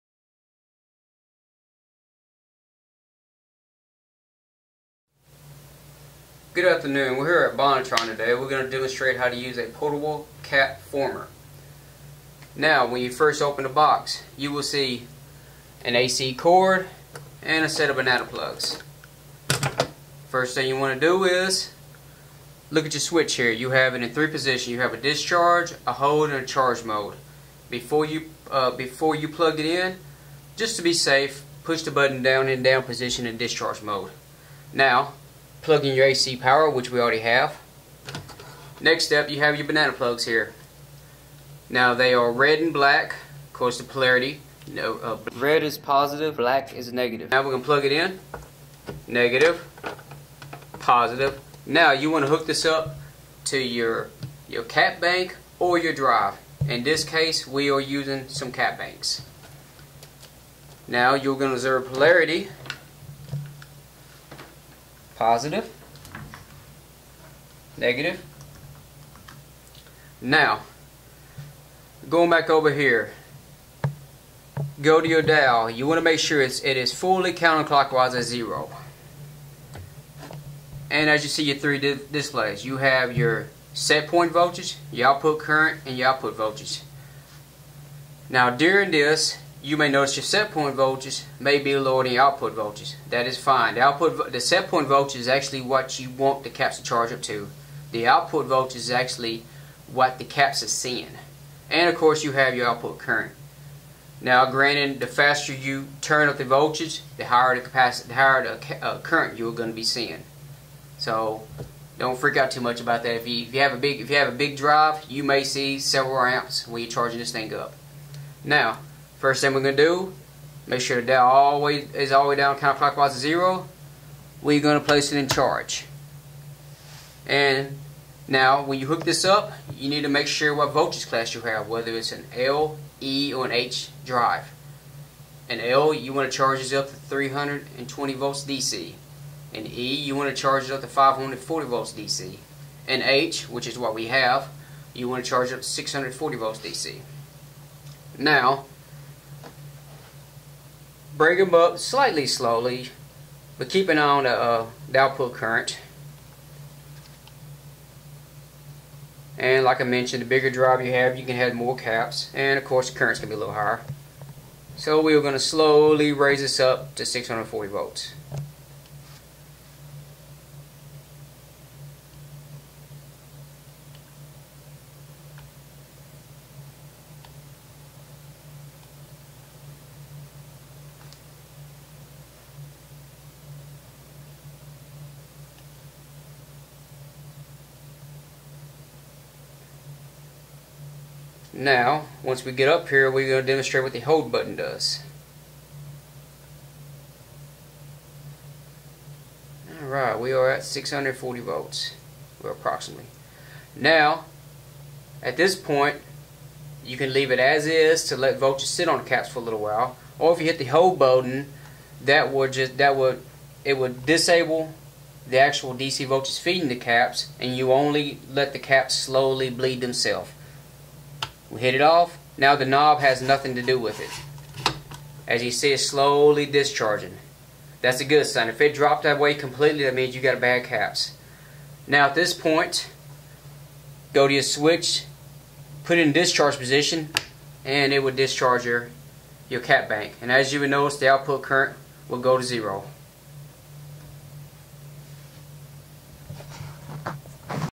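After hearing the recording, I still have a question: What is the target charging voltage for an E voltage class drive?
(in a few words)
540 volts DC.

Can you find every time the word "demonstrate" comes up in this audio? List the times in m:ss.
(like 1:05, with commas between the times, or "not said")
0:08, 3:13.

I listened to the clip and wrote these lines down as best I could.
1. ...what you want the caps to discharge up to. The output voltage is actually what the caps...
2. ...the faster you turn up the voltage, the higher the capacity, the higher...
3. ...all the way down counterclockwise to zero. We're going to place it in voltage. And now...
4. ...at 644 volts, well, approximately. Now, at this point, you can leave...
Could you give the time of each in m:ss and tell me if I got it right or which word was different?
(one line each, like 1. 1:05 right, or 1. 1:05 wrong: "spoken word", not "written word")
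1. 1:35 wrong: "charge", not "discharge"
2. 1:44 right
3. 2:02 wrong: "charge", not "voltage"
4. 3:20 wrong: "640", not "644".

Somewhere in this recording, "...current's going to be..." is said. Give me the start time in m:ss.
2:42.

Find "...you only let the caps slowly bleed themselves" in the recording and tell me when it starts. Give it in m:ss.
3:37.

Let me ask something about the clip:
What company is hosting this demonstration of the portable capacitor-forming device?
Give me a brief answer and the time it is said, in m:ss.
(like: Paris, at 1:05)
Bonitron, at 0:07.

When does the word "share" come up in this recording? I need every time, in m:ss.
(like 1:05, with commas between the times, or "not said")
not said.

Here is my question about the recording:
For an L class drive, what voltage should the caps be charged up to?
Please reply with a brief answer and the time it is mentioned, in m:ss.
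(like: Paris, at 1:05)
320 volts DC, at 2:16.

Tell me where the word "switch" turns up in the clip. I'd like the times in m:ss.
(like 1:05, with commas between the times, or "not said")
0:22, 3:54.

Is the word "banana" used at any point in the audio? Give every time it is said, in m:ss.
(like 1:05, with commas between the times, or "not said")
0:17, 0:39.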